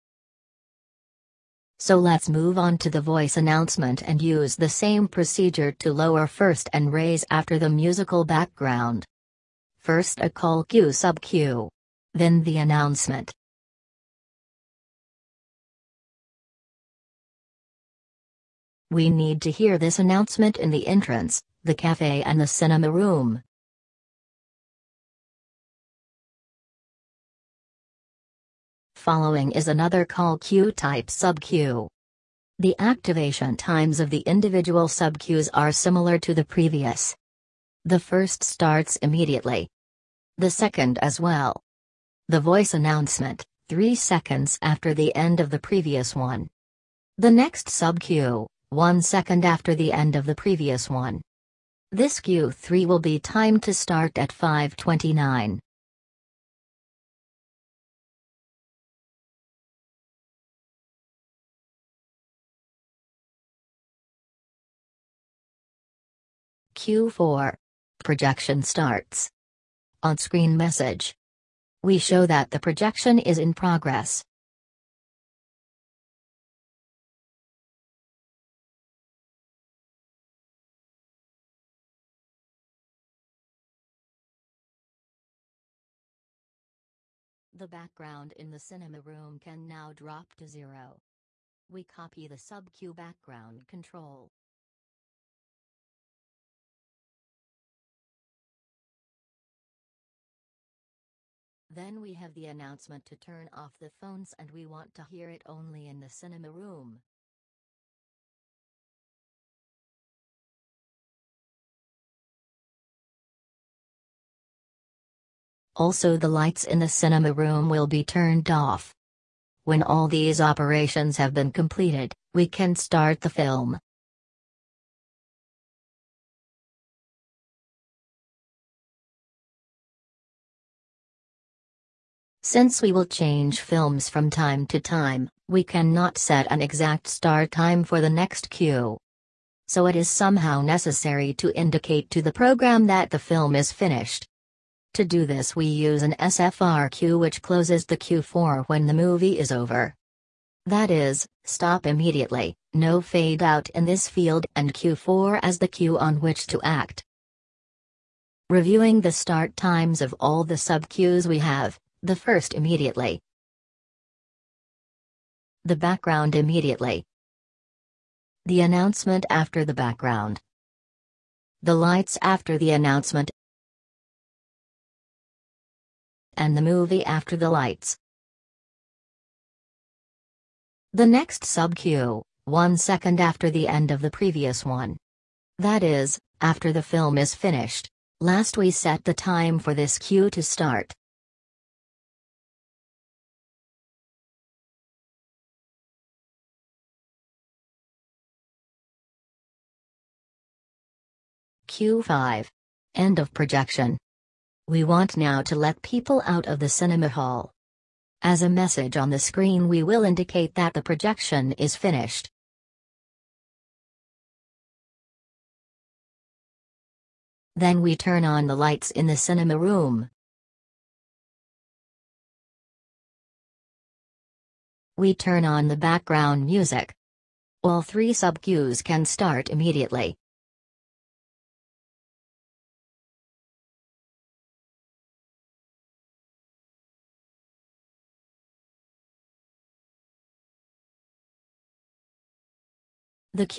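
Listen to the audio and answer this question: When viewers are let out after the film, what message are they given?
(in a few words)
The projection is finished.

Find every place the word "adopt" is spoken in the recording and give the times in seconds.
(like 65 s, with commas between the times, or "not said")
not said.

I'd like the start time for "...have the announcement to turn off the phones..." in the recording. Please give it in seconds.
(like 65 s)
102 s.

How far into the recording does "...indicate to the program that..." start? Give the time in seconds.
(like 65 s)
141 s.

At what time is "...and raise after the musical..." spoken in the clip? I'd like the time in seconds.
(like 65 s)
6 s.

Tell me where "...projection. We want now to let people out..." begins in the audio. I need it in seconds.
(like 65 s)
203 s.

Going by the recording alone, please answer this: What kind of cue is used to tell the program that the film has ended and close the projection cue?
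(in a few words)
SFR cue.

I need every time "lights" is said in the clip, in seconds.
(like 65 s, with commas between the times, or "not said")
116 s, 171 s, 177 s, 218 s.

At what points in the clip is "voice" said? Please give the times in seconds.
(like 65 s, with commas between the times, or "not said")
3 s, 42 s.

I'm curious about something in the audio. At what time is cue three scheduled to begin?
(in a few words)
529.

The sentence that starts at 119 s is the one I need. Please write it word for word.
When all these operations have been completed, we can start the film.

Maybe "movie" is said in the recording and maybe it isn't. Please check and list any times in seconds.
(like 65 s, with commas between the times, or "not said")
148 s, 176 s.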